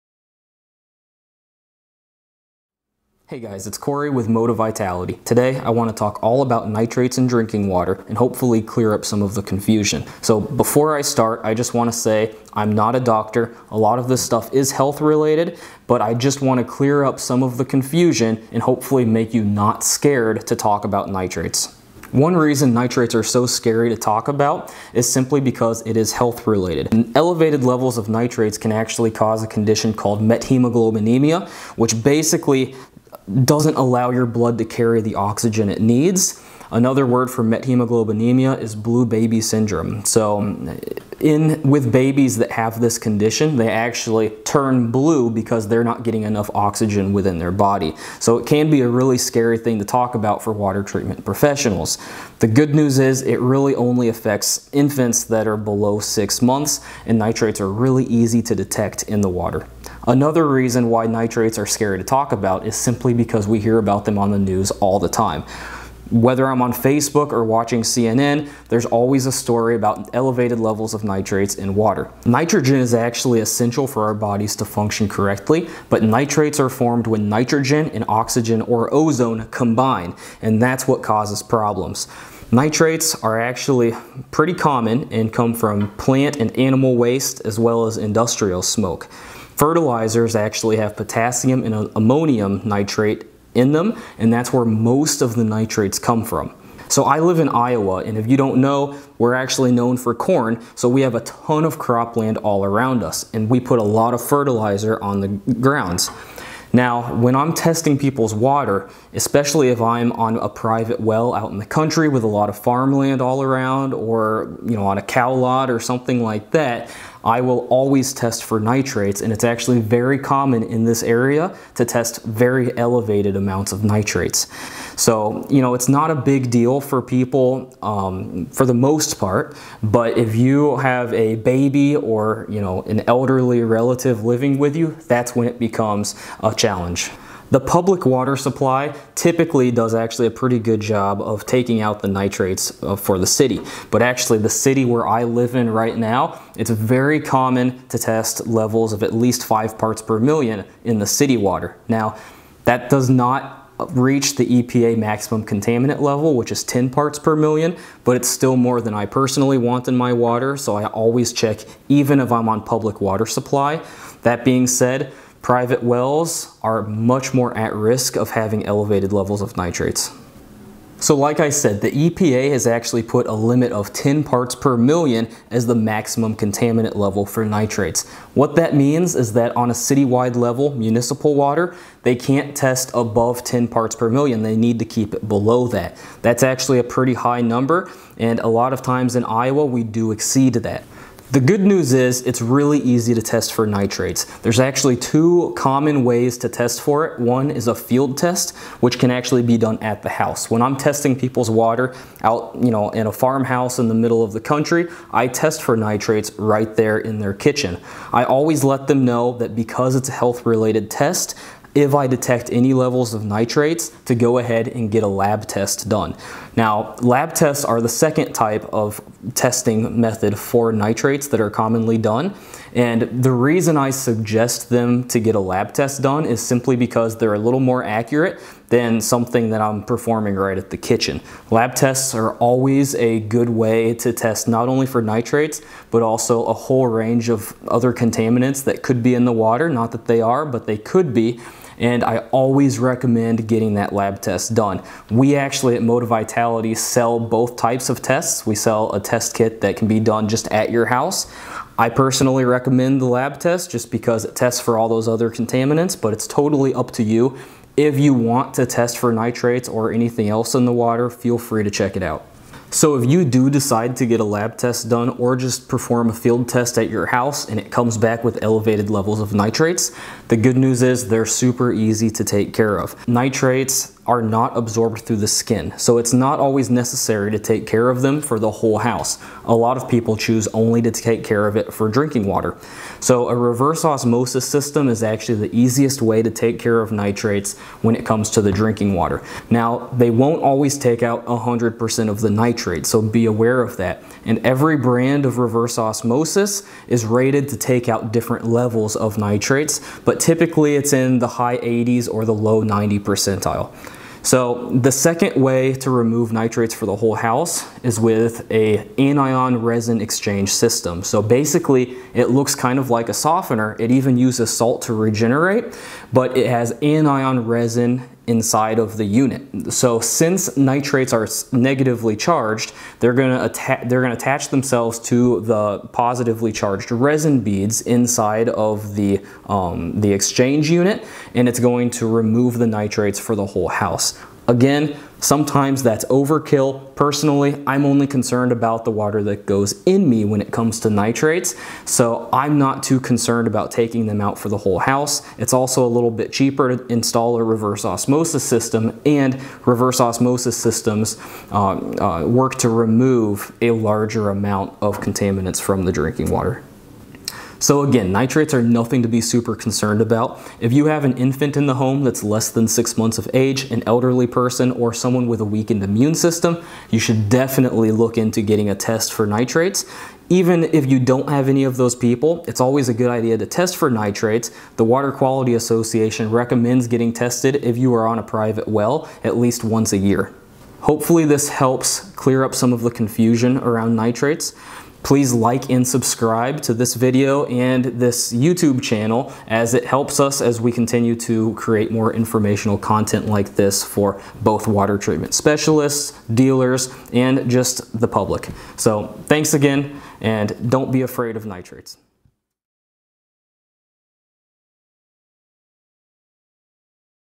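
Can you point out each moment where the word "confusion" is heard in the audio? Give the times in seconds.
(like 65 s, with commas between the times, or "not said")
9 s, 17 s, 382 s.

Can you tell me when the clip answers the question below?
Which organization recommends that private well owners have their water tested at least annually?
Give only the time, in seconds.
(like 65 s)
374 s.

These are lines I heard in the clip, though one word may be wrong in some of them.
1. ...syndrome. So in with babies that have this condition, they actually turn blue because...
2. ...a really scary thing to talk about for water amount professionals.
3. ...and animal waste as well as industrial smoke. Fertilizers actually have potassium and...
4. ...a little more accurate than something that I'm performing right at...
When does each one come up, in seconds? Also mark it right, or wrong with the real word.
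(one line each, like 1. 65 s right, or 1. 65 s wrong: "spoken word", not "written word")
1. 39 s right
2. 48 s wrong: "treatment", not "amount"
3. 86 s right
4. 227 s right.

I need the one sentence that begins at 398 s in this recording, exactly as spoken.
So thanks again and don't be afraid of nitrates.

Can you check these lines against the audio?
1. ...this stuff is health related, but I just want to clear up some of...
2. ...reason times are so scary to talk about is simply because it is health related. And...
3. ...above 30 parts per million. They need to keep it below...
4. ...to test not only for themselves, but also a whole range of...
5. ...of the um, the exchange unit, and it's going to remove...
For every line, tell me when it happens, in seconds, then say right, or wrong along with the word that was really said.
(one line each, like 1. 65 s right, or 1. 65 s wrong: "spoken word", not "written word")
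1. 14 s right
2. 22 s wrong: "nitrates", not "times"
3. 182 s wrong: "10", not "30"
4. 233 s wrong: "nitrates", not "themselves"
5. 328 s right.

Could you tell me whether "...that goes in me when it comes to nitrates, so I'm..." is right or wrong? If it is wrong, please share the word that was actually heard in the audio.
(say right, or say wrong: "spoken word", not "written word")
right.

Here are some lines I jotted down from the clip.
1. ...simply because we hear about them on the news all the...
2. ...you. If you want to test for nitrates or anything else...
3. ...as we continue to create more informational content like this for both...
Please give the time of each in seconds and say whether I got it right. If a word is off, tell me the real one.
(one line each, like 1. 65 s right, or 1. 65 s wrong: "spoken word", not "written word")
1. 62 s right
2. 257 s right
3. 390 s right.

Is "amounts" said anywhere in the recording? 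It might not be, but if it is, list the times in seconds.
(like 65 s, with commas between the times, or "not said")
123 s, 354 s.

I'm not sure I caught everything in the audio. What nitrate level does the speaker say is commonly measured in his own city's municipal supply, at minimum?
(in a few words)
5 parts per million.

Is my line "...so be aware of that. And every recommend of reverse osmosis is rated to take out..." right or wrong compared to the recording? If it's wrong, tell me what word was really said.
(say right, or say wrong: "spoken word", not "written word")
wrong: "brand", not "recommend".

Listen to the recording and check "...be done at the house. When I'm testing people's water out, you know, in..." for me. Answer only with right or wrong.
right.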